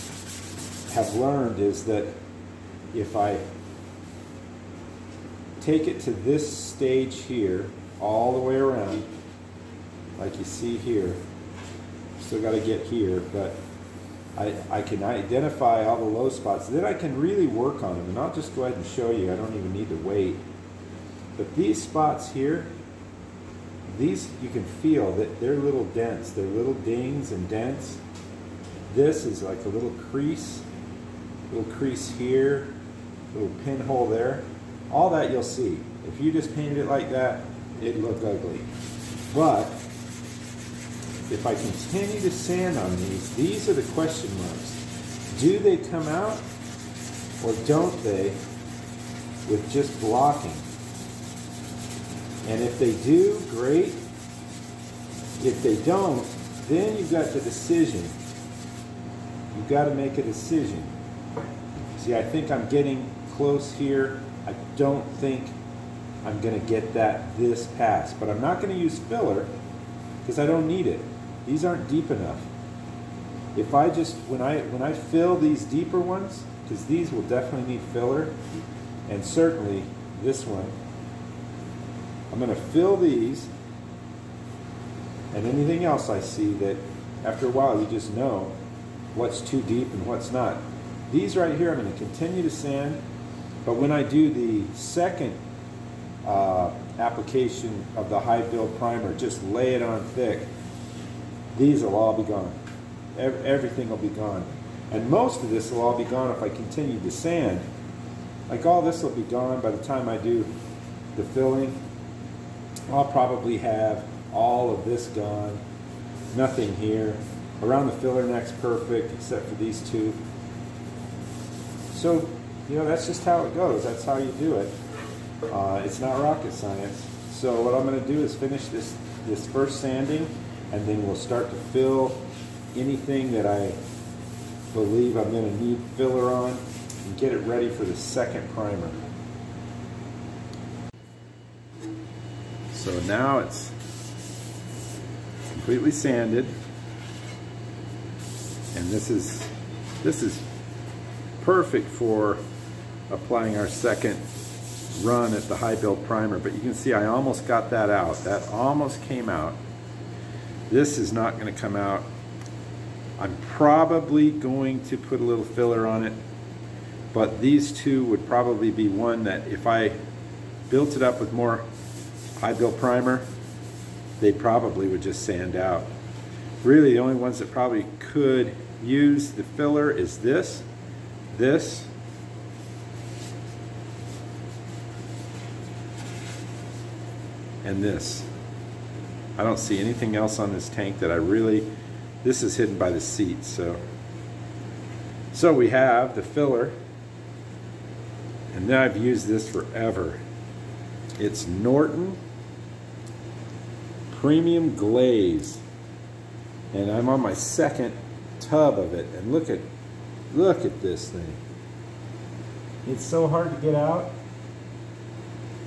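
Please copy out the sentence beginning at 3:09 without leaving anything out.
I don't see anything else on this tank that I really, this is hidden by the seat, so.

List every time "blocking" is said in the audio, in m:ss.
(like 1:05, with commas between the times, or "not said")
0:50.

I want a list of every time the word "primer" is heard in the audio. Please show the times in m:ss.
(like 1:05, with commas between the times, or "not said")
1:38, 2:18, 2:36, 2:52.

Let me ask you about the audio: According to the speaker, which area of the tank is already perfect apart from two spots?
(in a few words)
filler neck.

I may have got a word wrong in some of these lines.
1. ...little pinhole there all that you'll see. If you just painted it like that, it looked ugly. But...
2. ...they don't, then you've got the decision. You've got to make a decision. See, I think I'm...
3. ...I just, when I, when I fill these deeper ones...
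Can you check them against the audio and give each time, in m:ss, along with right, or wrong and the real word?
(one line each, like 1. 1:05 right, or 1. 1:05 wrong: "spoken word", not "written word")
1. 0:33 right
2. 0:55 right
3. 1:13 right.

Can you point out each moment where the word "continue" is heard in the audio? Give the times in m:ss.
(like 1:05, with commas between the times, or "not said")
0:41, 1:31, 1:46.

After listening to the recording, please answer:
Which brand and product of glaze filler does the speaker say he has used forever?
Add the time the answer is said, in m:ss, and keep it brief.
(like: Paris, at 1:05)
Norton Premium Glaze, at 3:21.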